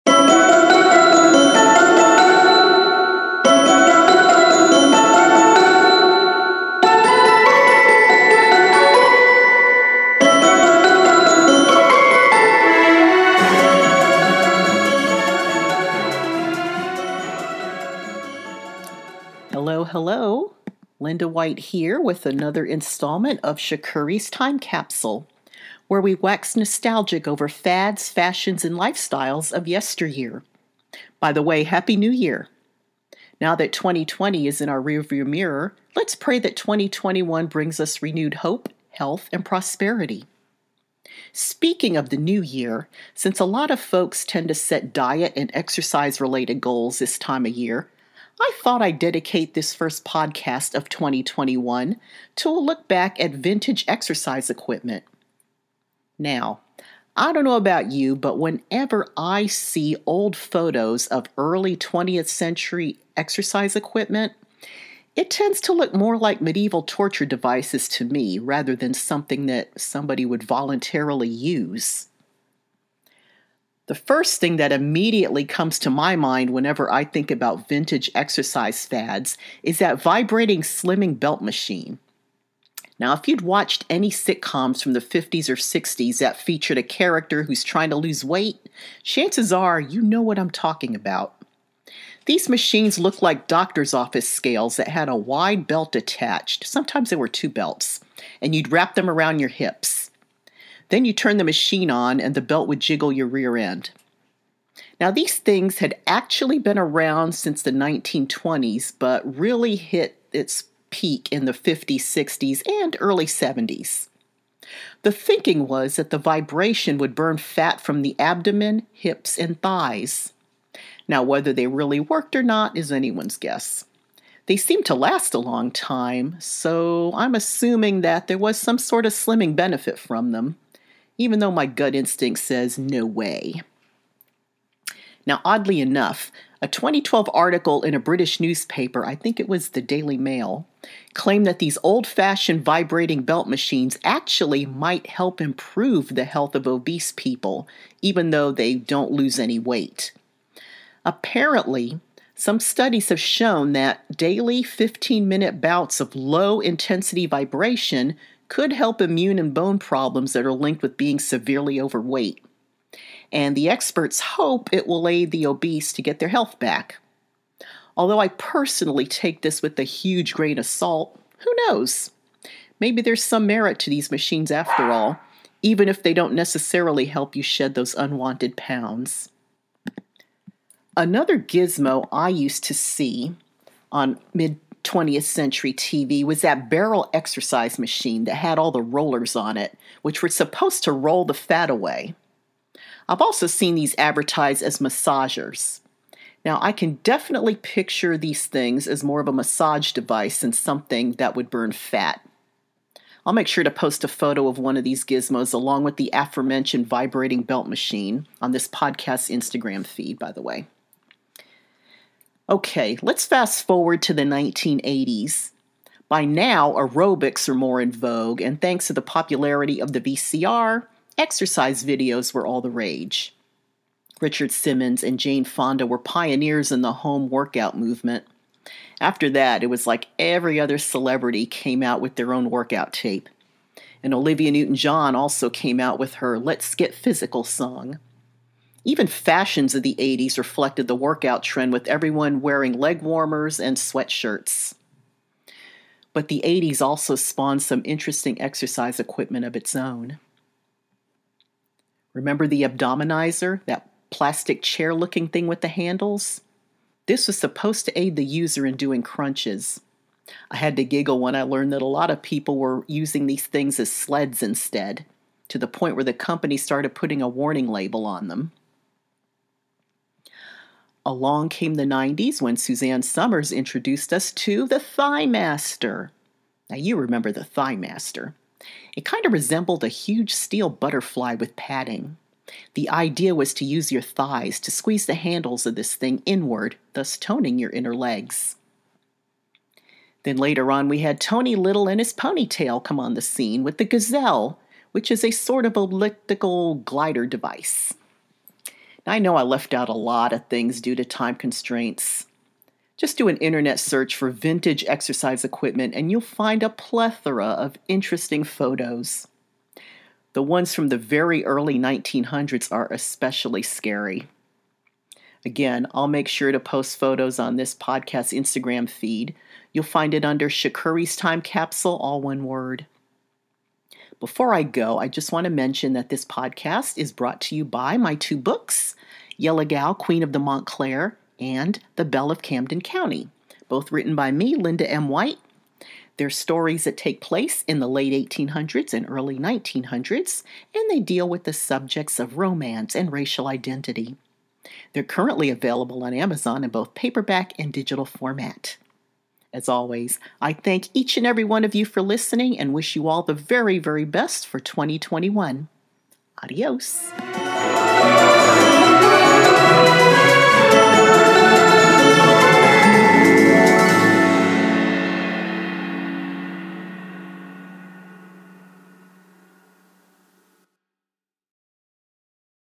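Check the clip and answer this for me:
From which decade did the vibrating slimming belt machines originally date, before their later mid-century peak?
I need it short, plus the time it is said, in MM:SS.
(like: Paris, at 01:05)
1920s, at 01:47.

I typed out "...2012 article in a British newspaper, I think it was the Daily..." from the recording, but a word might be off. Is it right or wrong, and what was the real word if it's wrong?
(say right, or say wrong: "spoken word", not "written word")
right.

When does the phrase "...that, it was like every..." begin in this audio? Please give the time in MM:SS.
03:49.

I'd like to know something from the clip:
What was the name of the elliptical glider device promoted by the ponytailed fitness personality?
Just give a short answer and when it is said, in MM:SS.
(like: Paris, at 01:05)
the Gazelle, at 04:53.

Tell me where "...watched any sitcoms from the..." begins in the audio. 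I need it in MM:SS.
01:23.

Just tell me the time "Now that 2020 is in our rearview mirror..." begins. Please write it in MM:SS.
00:33.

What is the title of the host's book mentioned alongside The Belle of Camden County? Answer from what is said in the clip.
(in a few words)
Yellow Gal, Queen of the Montclair.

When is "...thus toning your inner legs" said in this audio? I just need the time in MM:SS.
04:46.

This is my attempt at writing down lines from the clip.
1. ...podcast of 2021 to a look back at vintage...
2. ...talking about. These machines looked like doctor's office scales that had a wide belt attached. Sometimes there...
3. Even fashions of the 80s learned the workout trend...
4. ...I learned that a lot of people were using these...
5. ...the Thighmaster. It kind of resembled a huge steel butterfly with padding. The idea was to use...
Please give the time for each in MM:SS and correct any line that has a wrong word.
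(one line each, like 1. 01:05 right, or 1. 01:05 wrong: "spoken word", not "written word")
1. 00:50 right
2. 01:30 right
3. 03:58 wrong: "reflected", not "learned"
4. 04:21 right
5. 04:37 right.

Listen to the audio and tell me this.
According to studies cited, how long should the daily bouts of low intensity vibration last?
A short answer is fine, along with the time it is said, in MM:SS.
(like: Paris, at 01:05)
15 minutes, at 02:34.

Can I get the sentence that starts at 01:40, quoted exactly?
Then you turn the machine on and the belt would jiggle your rear end.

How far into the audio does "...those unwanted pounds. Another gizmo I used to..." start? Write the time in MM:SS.
02:57.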